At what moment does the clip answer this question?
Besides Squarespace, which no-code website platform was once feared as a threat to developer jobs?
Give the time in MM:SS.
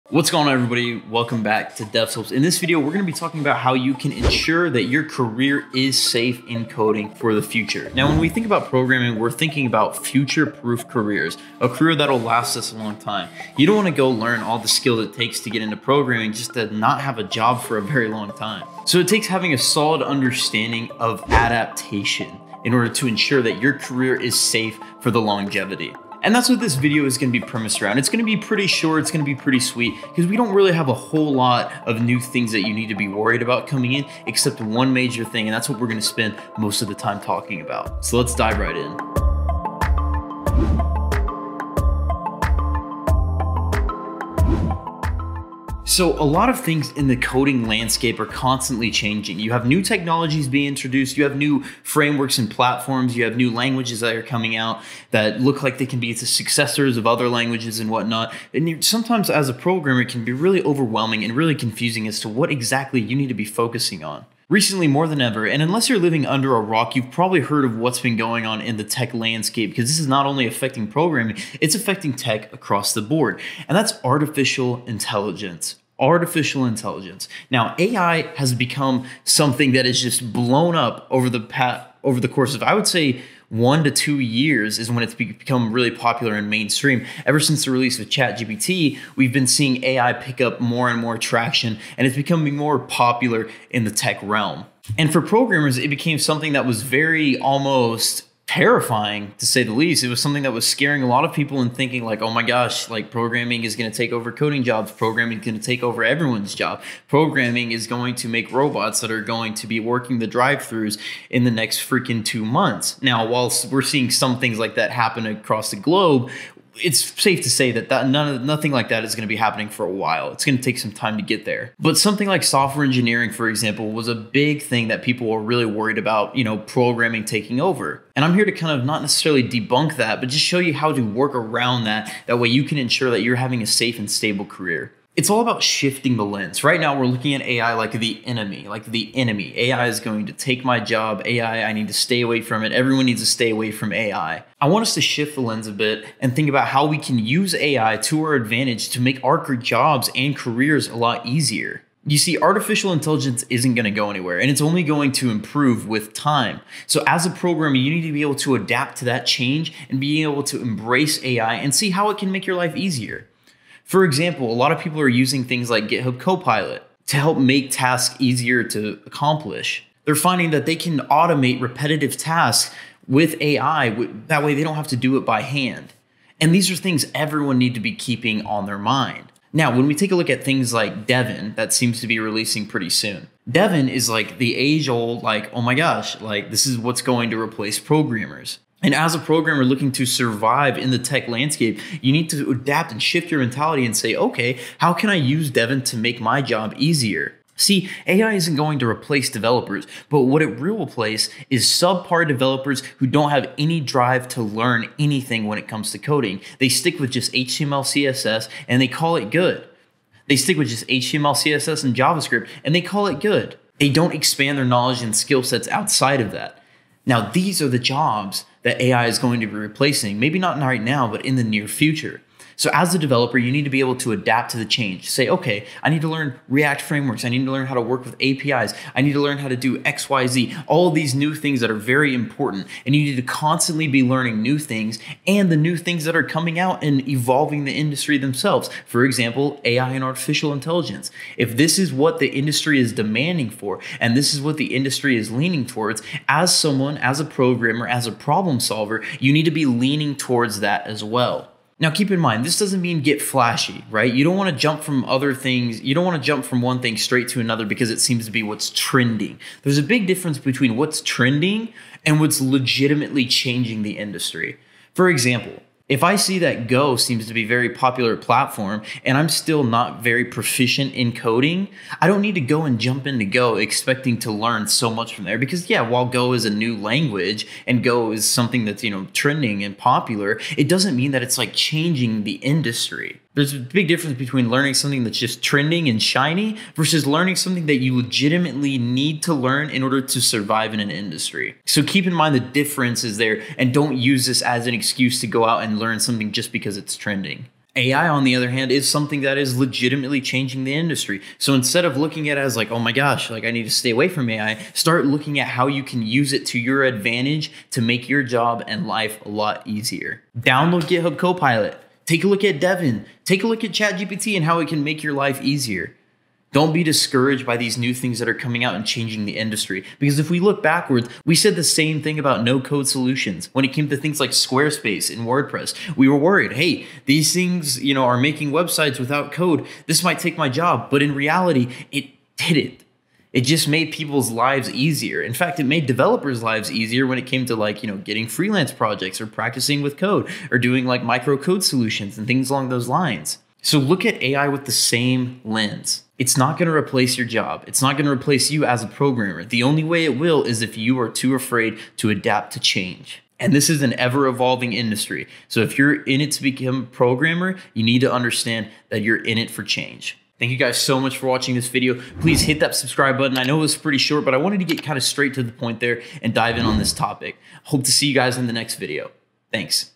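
05:25.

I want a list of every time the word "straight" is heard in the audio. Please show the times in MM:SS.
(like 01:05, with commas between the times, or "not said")
04:16, 06:05.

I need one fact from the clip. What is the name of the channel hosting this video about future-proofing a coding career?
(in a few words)
Devslopes.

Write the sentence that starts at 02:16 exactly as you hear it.
Right now, we're looking at AI like the enemy, like the enemy.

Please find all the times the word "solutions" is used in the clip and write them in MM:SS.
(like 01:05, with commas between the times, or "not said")
05:22, 05:41.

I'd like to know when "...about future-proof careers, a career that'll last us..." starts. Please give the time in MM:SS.
00:09.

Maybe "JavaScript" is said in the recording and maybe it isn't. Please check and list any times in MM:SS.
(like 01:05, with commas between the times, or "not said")
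03:31.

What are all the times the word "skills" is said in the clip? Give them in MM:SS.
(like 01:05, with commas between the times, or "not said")
00:14, 03:35.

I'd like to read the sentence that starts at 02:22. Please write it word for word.
Everyone needs to stay away from AI.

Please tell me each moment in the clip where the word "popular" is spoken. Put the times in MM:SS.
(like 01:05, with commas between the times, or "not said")
01:25, 01:32, 04:27, 04:39.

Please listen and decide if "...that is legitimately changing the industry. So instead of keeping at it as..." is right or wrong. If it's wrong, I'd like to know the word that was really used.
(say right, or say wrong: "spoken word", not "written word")
wrong: "looking", not "keeping".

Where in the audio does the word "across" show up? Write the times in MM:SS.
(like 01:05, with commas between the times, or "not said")
01:12, 01:55.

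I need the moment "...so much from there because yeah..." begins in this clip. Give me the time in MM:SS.
04:34.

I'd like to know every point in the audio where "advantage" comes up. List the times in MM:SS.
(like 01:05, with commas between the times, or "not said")
02:28, 05:06.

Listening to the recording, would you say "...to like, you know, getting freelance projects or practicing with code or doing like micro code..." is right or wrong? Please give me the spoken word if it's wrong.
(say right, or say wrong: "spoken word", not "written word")
right.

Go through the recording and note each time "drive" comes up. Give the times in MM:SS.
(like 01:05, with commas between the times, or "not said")
01:50, 03:23.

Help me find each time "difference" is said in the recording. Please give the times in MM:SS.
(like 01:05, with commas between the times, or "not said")
04:20, 04:43, 04:52.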